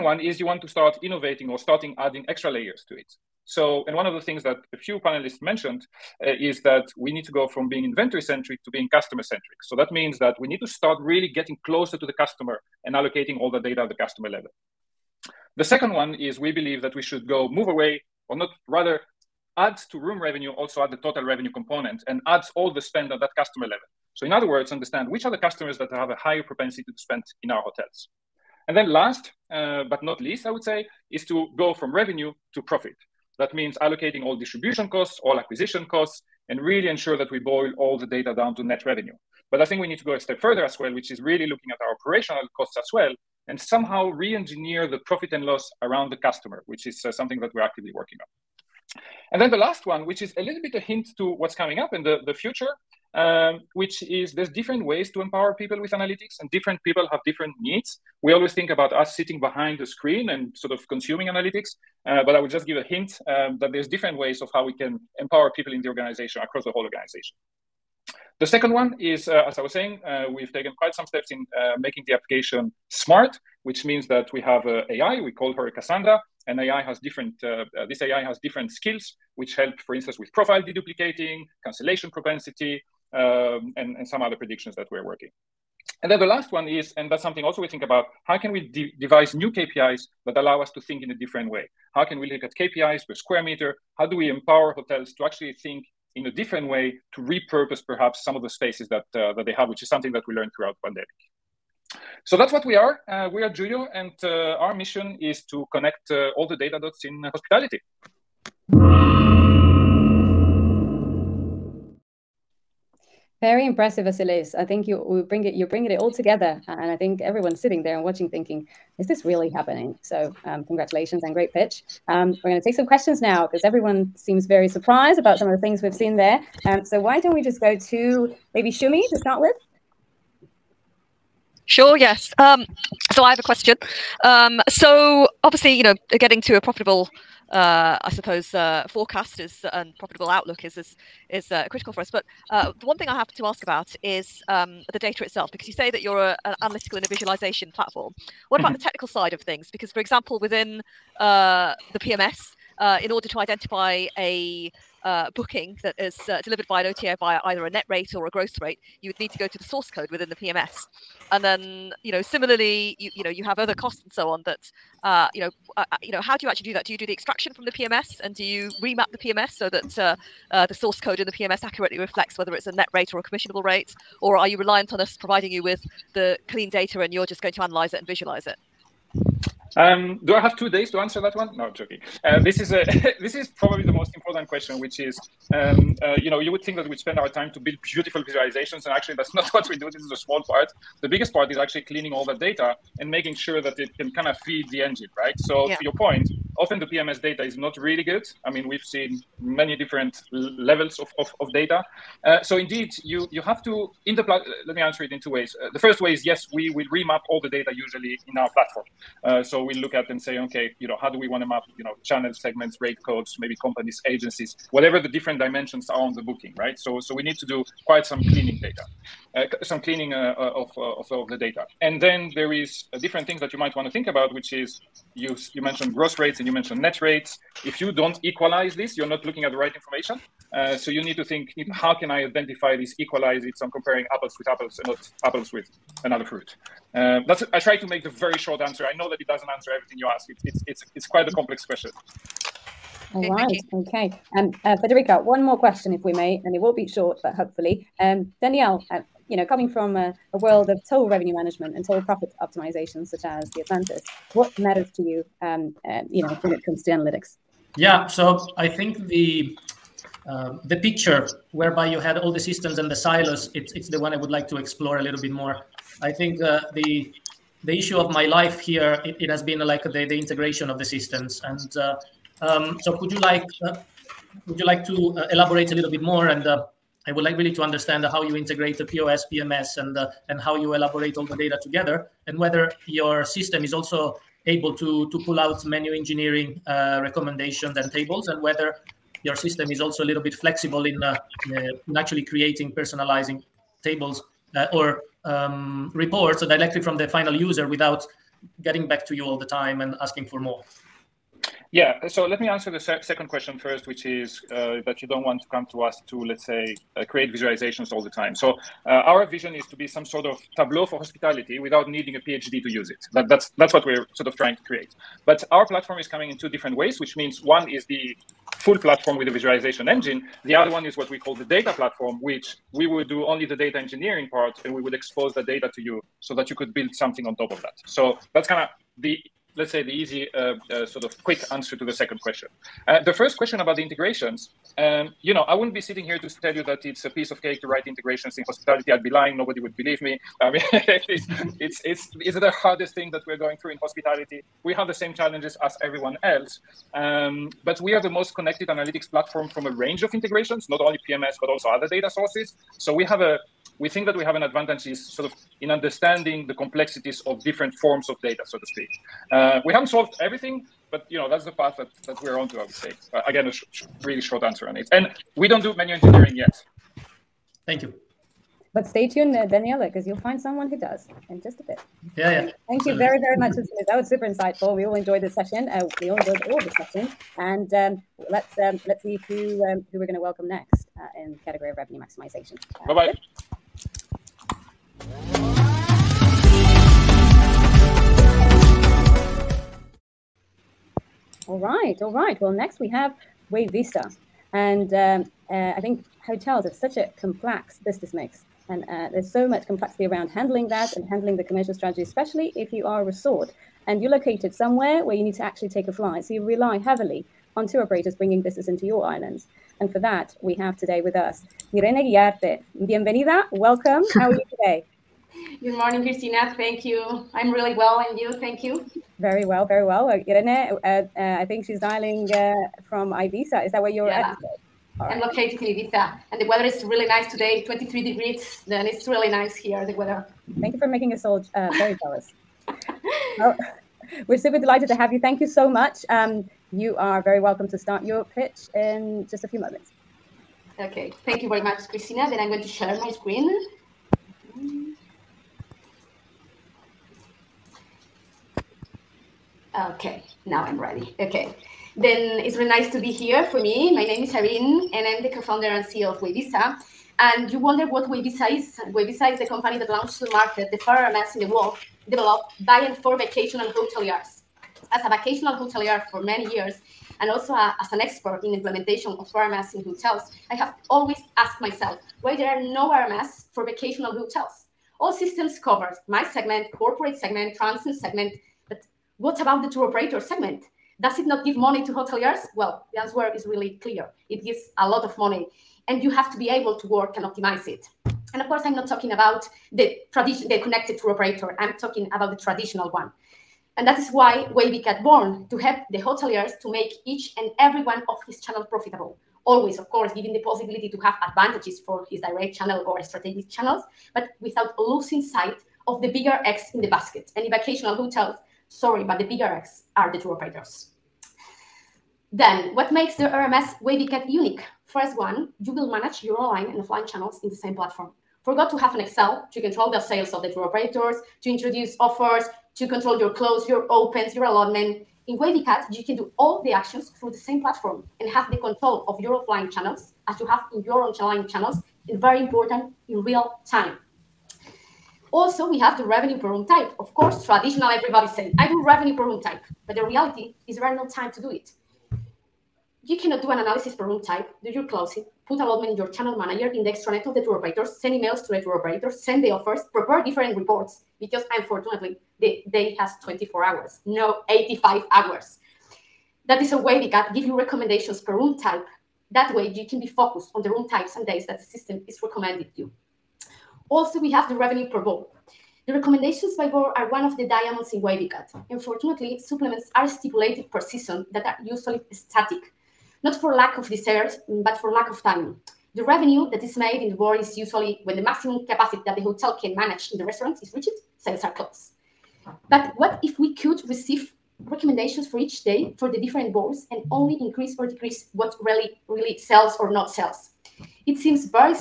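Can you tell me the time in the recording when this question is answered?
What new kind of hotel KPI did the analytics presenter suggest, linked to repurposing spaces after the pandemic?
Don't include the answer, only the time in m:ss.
1:32.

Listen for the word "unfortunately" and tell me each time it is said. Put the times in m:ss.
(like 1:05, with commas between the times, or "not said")
9:11, 9:28.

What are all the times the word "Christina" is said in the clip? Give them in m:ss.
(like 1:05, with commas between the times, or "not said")
6:56, 7:21.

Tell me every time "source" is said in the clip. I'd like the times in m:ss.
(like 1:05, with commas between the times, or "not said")
2:39, 2:50, 5:52.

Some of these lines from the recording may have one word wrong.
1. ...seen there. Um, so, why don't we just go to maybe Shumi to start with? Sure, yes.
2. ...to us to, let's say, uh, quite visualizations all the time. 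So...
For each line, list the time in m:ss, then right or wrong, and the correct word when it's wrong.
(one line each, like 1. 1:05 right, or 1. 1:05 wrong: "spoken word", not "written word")
1. 2:06 right
2. 5:05 wrong: "create", not "quite".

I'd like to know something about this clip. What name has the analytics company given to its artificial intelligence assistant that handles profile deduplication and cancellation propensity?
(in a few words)
Cassandra.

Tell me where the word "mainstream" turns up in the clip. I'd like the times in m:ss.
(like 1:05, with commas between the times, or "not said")
not said.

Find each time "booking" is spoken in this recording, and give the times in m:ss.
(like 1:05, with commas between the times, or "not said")
2:35, 3:36.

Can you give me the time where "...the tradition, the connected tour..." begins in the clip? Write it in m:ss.
8:09.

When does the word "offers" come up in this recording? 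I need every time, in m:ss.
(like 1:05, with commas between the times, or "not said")
8:41, 9:09.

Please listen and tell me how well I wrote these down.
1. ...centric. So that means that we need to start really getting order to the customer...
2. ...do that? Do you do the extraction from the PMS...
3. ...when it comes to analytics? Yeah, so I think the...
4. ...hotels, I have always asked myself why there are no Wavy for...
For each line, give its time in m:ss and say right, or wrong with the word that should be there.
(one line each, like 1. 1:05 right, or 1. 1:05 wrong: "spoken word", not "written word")
1. 0:09 wrong: "closer", not "order"
2. 2:46 right
3. 4:16 right
4. 7:49 wrong: "RMS", not "Wavy".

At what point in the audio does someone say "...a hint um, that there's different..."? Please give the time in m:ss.
1:02.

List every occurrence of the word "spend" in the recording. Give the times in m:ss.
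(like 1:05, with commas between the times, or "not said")
0:22, 0:26, 3:06.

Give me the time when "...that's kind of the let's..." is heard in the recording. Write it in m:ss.
5:28.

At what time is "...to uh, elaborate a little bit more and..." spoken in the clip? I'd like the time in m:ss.
4:34.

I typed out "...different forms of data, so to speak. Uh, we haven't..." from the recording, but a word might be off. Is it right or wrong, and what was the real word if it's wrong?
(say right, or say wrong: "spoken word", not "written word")
right.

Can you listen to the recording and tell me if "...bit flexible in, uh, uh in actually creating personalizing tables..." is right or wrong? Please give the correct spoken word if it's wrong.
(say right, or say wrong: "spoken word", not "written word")
right.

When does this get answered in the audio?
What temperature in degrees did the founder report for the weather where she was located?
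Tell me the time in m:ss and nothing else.
7:07.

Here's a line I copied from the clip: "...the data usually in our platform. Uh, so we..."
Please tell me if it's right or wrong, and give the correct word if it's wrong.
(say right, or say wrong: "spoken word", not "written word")
right.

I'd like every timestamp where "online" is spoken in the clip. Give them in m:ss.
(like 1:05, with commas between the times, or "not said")
8:36, 8:51.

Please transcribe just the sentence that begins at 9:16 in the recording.
That is a way we can give you recommendations per room type.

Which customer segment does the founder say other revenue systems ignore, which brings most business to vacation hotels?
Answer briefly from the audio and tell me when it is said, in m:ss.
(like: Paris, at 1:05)
tour operator segment, at 7:59.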